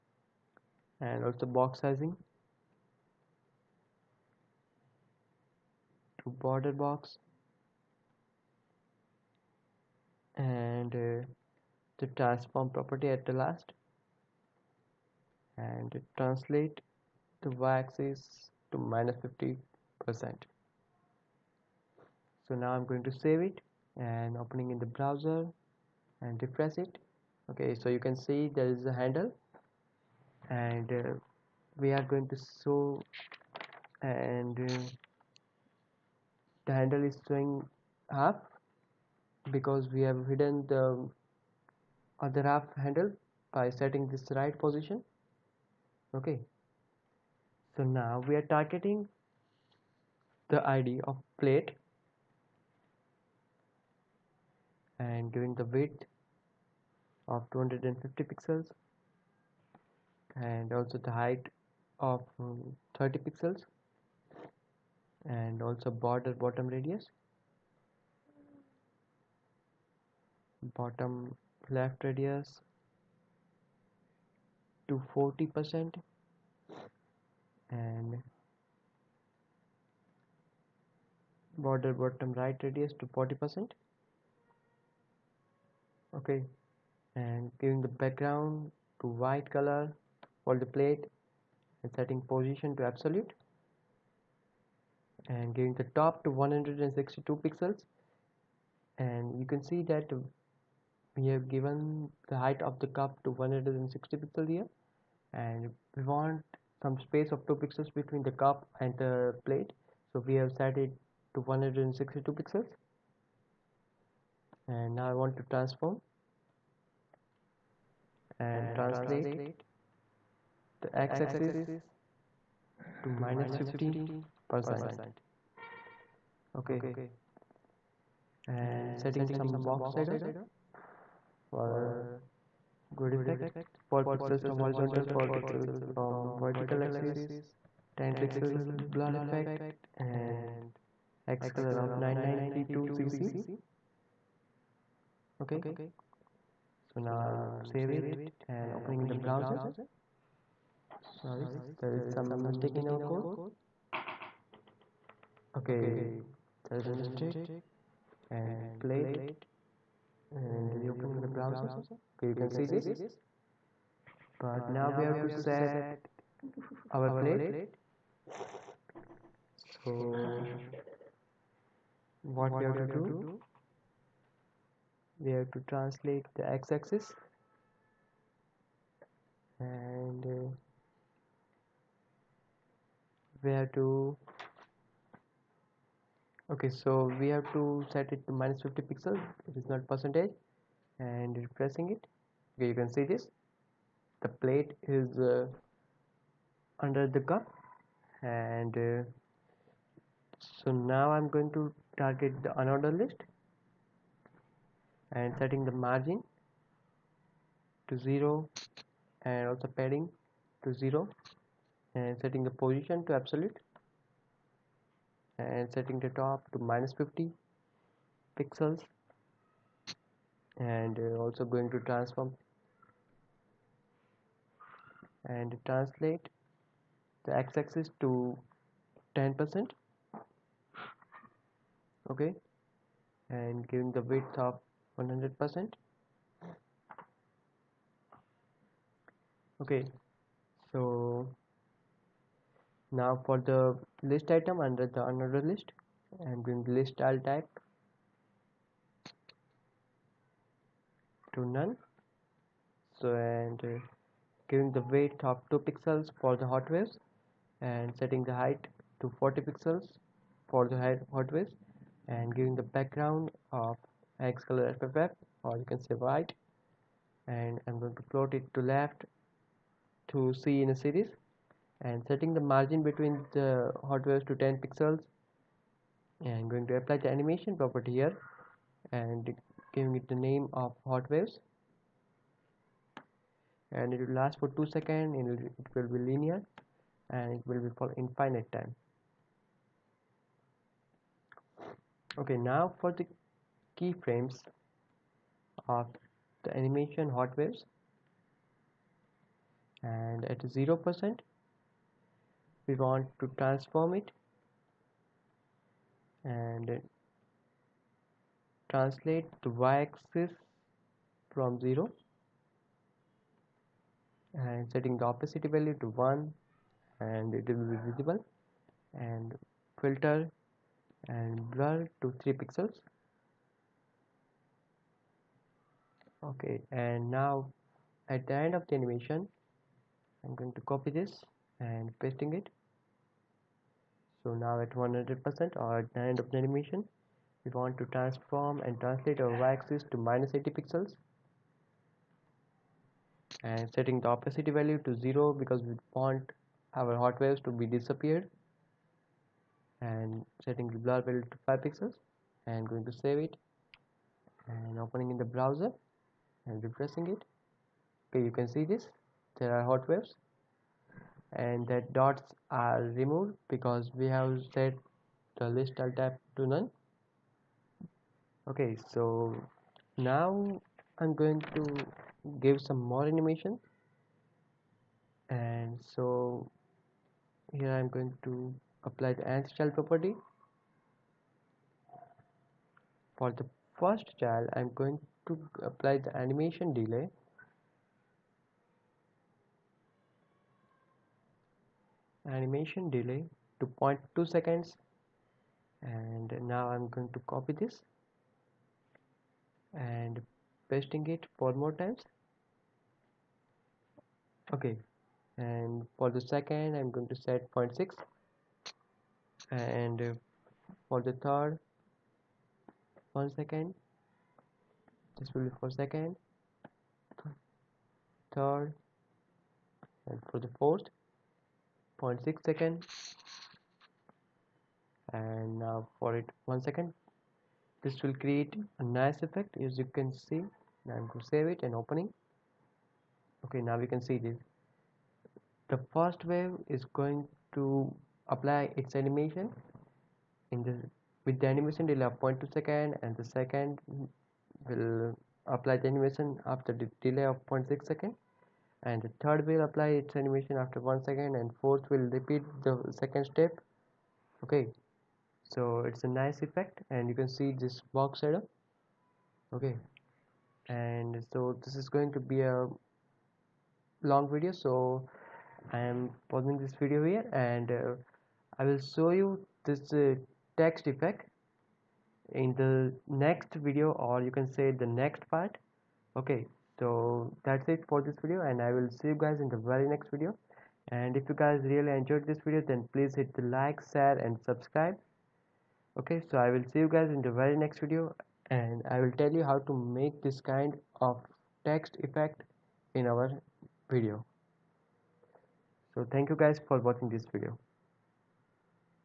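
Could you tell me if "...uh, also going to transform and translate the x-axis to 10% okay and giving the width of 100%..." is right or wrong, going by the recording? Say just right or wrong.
right.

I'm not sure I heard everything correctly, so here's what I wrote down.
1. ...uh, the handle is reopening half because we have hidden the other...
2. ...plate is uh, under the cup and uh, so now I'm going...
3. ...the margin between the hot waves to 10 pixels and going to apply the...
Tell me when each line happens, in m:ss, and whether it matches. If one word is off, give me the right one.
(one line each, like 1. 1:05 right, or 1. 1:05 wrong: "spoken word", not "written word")
1. 0:34 wrong: "showing", not "reopening"
2. 3:14 right
3. 4:32 right.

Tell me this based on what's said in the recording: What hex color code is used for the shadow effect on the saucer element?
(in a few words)
9932cc.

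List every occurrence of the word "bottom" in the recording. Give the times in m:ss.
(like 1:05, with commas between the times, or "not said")
1:06, 1:10, 1:21.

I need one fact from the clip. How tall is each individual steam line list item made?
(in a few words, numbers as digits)
40 pixels.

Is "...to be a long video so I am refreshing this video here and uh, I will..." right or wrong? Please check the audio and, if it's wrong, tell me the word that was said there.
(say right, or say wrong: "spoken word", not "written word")
wrong: "pausing", not "refreshing".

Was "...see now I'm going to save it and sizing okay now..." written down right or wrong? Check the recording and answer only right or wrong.
wrong.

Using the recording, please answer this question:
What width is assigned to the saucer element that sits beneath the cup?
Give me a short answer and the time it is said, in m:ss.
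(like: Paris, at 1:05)
250 pixels, at 0:57.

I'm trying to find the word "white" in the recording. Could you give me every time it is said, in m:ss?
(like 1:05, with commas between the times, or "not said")
1:29, 4:25.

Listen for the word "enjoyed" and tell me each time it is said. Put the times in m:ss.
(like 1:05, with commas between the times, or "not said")
8:01.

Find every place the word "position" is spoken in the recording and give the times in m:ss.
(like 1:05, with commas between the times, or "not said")
0:44, 1:32, 3:32.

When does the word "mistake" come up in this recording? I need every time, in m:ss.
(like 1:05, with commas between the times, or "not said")
2:32, 2:36.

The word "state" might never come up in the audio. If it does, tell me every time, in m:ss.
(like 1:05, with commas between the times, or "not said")
not said.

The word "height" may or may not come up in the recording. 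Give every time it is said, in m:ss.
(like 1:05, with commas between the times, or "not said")
1:01, 1:42, 4:18.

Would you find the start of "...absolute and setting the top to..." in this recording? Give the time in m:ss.
3:33.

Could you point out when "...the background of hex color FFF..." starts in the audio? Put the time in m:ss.
4:22.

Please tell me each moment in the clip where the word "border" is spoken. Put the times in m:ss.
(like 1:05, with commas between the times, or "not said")
0:06, 1:05, 1:21.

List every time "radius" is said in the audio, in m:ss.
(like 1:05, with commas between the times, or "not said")
1:06, 1:12, 1:22.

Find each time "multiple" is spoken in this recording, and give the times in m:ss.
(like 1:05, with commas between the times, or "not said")
not said.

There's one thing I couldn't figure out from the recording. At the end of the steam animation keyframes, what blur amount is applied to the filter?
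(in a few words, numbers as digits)
5 pixels.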